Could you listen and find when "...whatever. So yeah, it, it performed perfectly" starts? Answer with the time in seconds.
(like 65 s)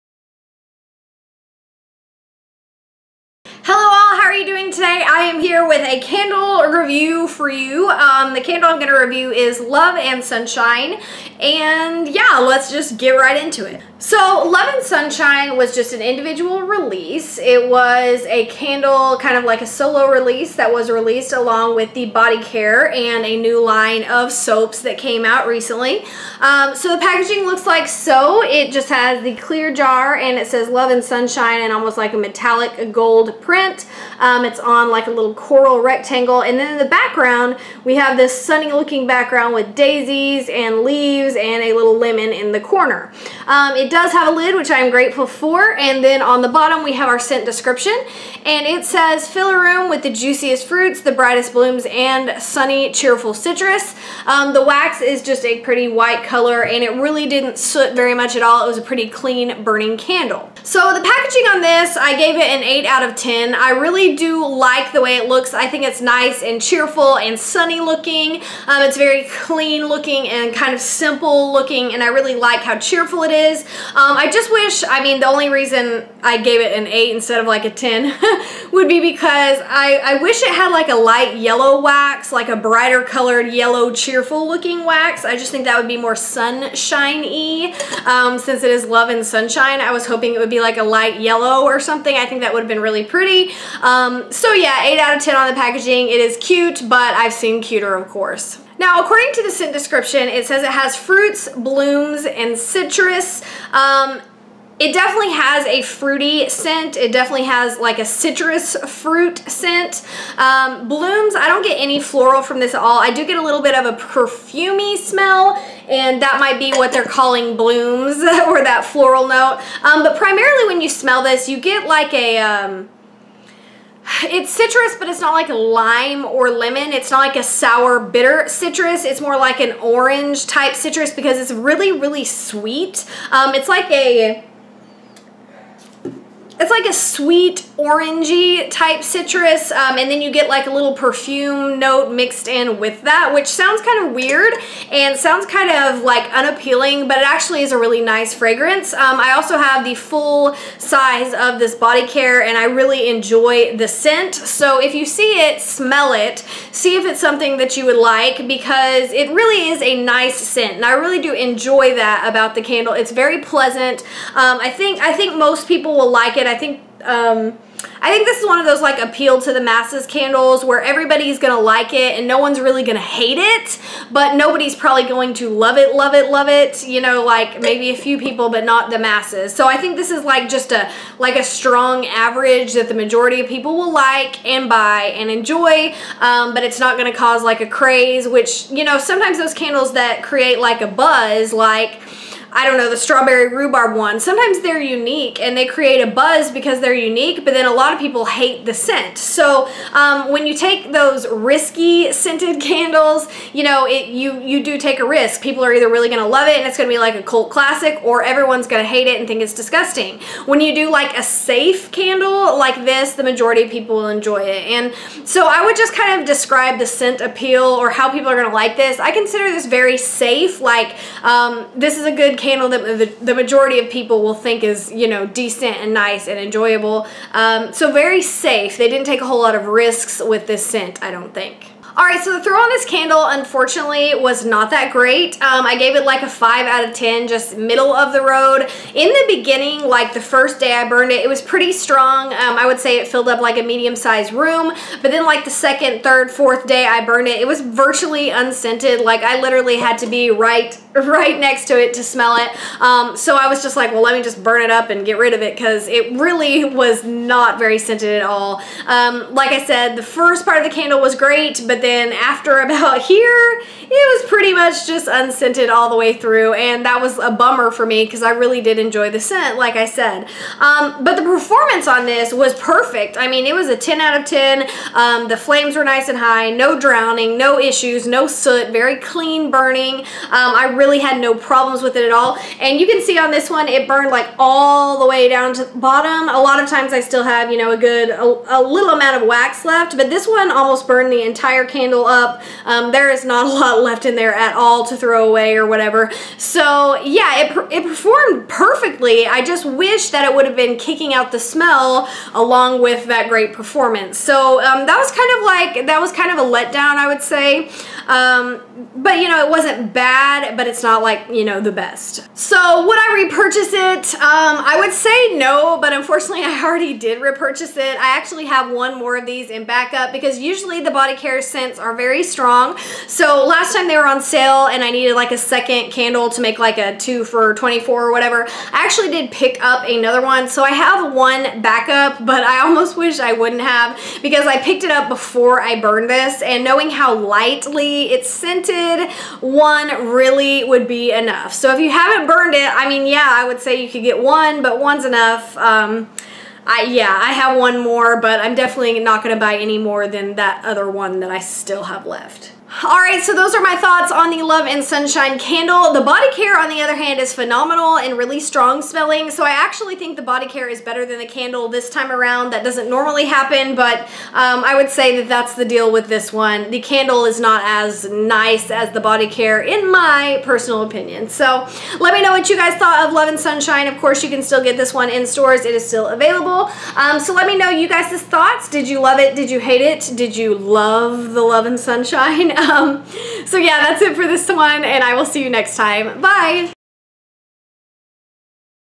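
295 s.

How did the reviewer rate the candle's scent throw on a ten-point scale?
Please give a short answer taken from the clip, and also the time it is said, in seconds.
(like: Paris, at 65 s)
5, at 236 s.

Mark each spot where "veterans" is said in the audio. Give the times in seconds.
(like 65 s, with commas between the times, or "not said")
not said.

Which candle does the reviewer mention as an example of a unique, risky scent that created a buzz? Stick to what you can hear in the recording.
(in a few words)
Strawberry rhubarb.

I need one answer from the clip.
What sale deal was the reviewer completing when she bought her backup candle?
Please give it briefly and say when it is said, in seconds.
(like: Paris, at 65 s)
Two for 24, at 326 s.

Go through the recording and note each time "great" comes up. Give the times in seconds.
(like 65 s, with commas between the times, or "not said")
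234 s, 261 s, 303 s.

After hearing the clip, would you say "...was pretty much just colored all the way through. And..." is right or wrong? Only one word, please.
wrong.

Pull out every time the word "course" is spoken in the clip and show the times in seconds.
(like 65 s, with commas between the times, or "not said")
98 s, 373 s.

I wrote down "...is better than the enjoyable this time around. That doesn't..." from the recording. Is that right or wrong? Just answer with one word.
wrong.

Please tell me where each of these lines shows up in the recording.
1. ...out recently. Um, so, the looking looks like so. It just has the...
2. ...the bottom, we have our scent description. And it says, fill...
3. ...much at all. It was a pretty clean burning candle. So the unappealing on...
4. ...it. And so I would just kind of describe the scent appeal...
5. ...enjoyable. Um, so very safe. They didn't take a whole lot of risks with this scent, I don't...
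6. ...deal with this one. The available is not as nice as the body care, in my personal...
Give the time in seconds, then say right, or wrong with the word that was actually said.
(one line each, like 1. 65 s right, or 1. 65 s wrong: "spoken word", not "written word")
1. 25 s wrong: "packaging", not "looking"
2. 46 s right
3. 58 s wrong: "packaging", not "unappealing"
4. 214 s right
5. 226 s right
6. 365 s wrong: "candle", not "available".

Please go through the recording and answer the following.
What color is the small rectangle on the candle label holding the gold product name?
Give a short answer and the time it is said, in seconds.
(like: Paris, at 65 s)
Coral, at 35 s.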